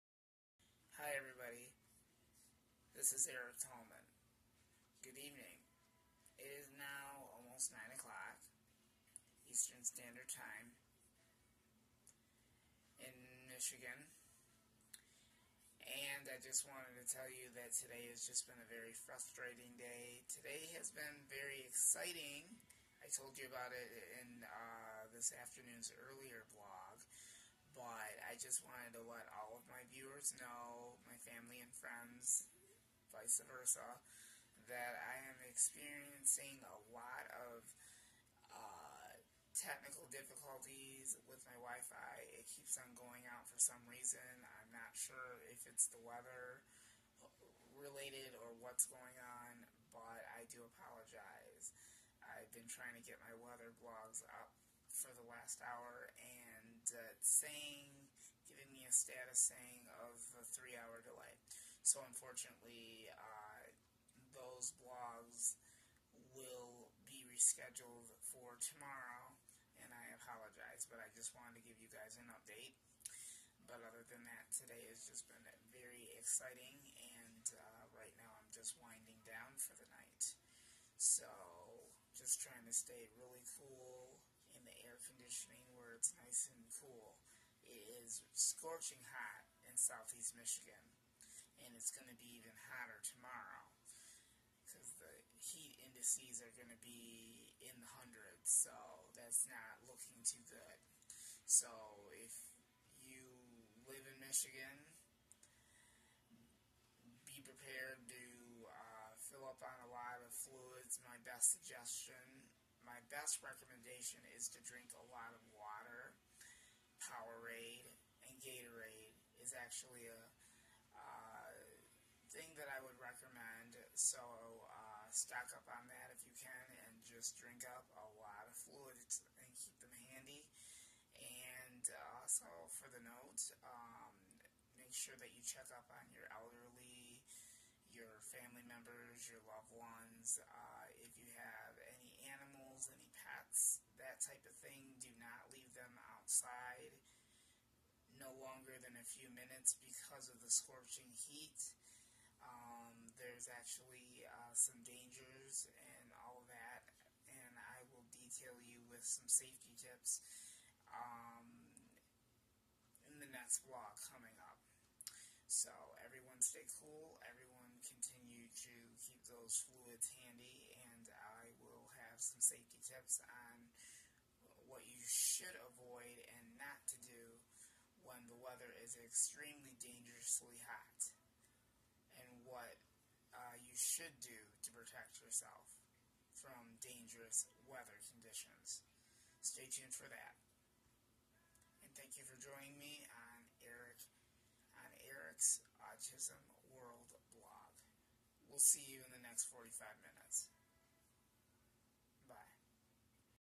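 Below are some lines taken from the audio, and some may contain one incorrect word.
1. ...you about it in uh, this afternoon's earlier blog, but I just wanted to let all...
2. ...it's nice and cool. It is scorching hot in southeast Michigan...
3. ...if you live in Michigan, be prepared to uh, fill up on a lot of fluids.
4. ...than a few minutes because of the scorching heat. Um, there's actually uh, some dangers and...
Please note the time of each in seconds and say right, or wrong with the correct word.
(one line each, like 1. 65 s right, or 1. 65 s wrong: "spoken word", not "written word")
1. 23 s right
2. 85 s right
3. 102 s right
4. 148 s right.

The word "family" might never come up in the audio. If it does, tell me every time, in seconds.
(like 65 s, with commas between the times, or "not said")
31 s, 138 s.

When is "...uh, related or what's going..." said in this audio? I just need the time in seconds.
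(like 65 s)
47 s.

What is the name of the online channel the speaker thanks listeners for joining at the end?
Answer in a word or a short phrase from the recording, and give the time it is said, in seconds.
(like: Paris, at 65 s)
Eric's Autism World, at 195 s.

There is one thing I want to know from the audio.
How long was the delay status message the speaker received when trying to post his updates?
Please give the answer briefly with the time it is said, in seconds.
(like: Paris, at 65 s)
3 hours, at 60 s.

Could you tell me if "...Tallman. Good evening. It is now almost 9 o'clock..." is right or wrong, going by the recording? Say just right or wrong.
right.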